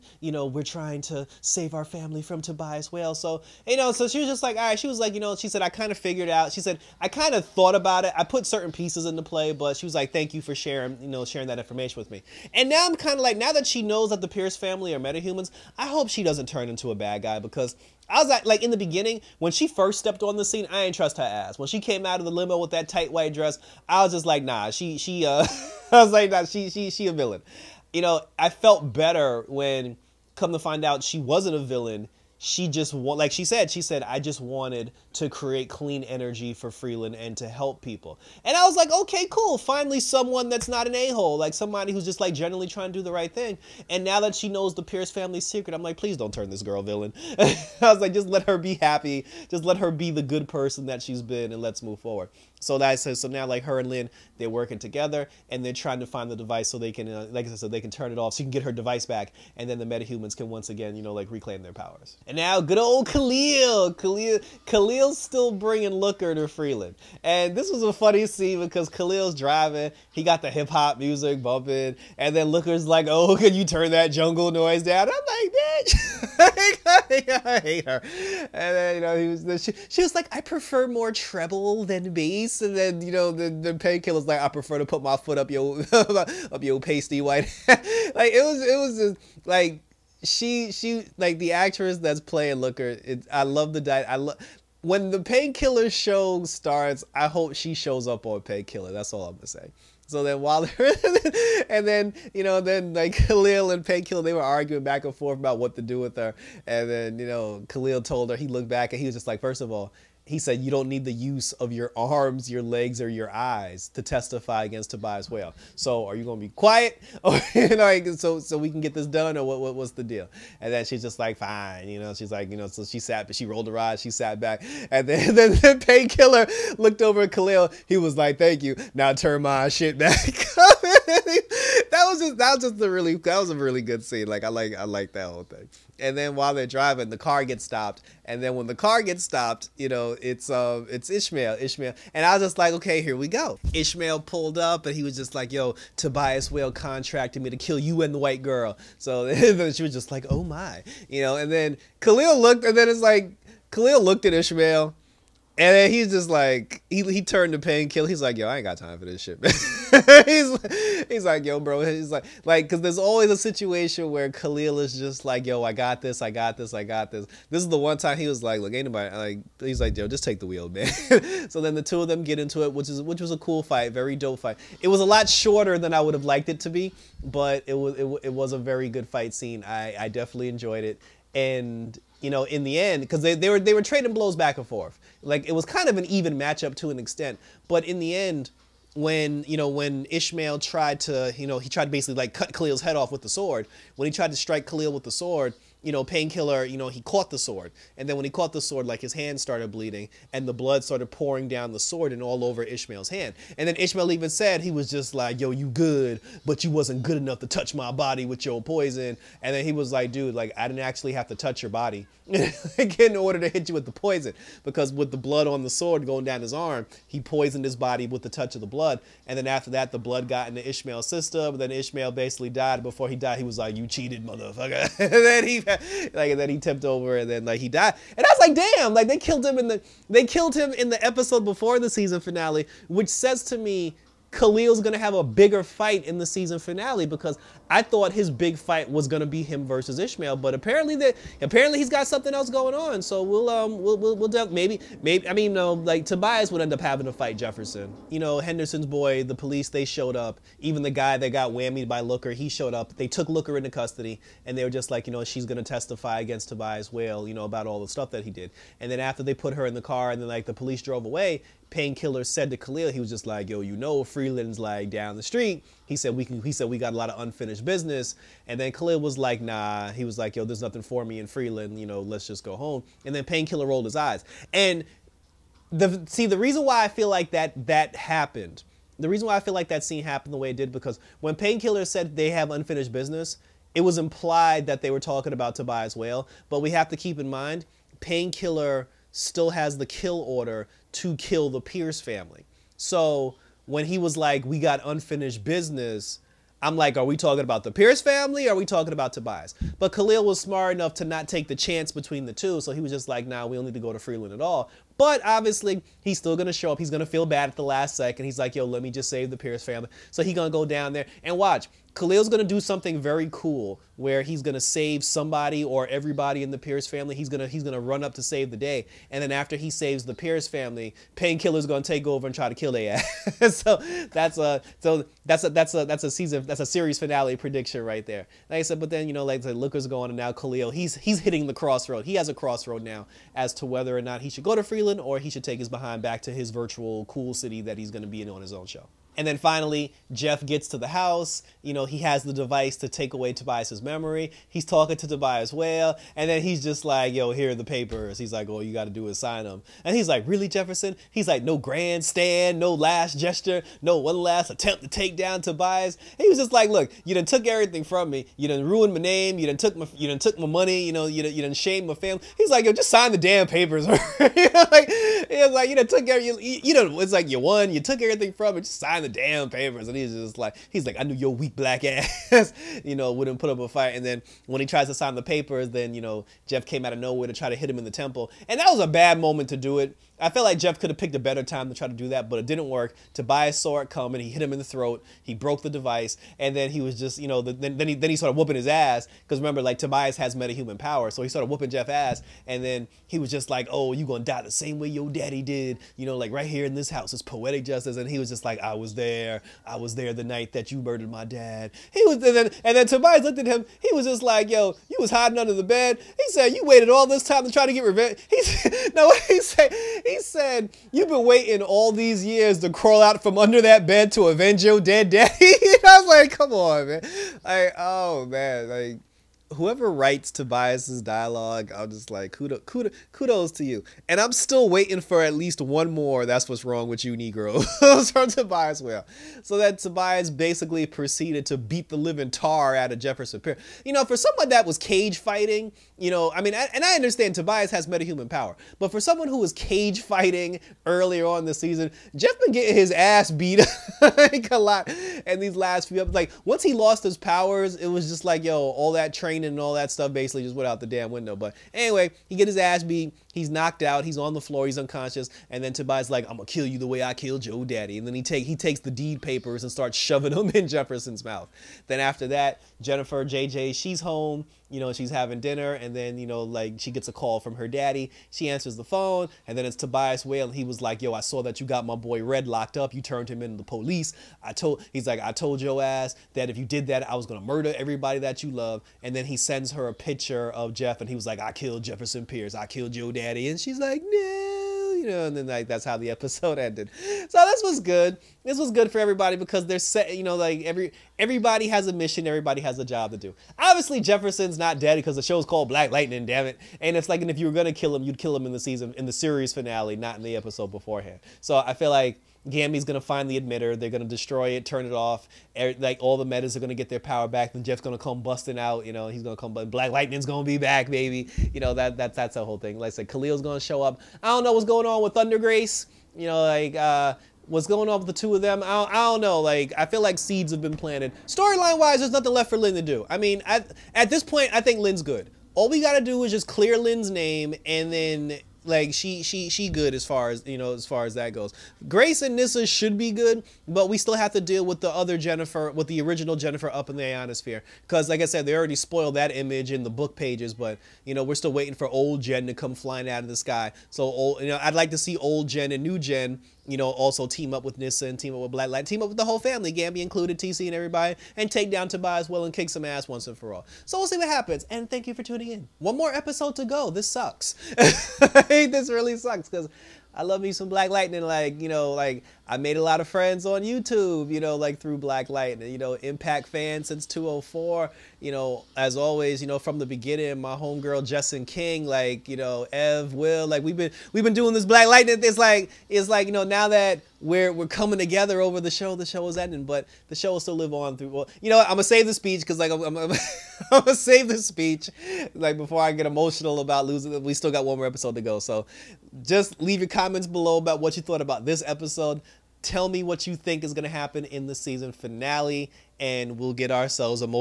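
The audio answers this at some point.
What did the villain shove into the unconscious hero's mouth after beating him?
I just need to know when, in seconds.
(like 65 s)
458 s.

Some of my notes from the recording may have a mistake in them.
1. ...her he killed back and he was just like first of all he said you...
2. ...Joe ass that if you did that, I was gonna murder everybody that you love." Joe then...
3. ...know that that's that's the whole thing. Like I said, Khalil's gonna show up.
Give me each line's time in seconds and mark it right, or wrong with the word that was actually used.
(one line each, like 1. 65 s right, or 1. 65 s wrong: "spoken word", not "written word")
1. 108 s wrong: "looked", not "killed"
2. 475 s wrong: "And", not "Joe"
3. 511 s right.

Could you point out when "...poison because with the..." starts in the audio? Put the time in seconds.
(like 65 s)
213 s.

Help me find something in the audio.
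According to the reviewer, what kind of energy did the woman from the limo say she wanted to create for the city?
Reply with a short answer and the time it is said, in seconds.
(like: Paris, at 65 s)
Clean energy, at 35 s.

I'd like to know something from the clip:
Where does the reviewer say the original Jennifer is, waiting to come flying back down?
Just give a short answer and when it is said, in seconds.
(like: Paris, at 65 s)
The ionosphere, at 537 s.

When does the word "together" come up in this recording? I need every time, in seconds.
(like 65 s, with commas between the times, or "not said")
54 s, 577 s.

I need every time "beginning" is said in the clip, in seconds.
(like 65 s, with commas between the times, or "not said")
18 s, 569 s.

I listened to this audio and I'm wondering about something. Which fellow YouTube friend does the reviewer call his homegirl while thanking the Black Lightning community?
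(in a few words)
Justin King.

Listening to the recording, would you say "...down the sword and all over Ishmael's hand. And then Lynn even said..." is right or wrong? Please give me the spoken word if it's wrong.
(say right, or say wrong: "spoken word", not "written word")
wrong: "Ishmael", not "Lynn".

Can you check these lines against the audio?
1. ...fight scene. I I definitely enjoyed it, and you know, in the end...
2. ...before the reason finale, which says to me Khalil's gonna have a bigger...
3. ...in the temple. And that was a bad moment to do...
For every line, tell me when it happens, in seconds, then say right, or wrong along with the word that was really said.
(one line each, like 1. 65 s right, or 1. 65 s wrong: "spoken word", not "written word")
1. 179 s right
2. 231 s wrong: "season", not "reason"
3. 377 s right.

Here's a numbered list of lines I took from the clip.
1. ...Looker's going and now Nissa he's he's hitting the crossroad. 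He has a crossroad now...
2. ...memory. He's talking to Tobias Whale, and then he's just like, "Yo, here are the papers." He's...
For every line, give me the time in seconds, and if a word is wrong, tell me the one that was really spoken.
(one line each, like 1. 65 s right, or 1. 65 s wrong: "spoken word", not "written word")
1. 329 s wrong: "Khalil", not "Nissa"
2. 343 s right.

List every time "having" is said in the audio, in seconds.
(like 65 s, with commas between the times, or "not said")
246 s, 465 s.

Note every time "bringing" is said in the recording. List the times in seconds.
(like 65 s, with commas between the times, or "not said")
65 s.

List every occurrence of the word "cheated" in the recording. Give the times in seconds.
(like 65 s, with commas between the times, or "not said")
223 s.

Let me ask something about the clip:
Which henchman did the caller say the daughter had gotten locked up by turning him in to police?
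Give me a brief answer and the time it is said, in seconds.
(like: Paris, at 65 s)
Red, at 472 s.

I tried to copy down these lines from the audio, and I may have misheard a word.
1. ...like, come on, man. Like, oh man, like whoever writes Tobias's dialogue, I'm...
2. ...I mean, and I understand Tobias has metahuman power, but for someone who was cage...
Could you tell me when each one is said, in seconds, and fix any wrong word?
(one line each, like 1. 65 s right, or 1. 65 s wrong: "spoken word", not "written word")
1. 416 s right
2. 436 s right.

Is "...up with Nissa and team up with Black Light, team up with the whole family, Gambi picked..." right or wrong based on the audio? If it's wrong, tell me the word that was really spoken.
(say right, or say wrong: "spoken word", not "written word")
wrong: "included", not "picked".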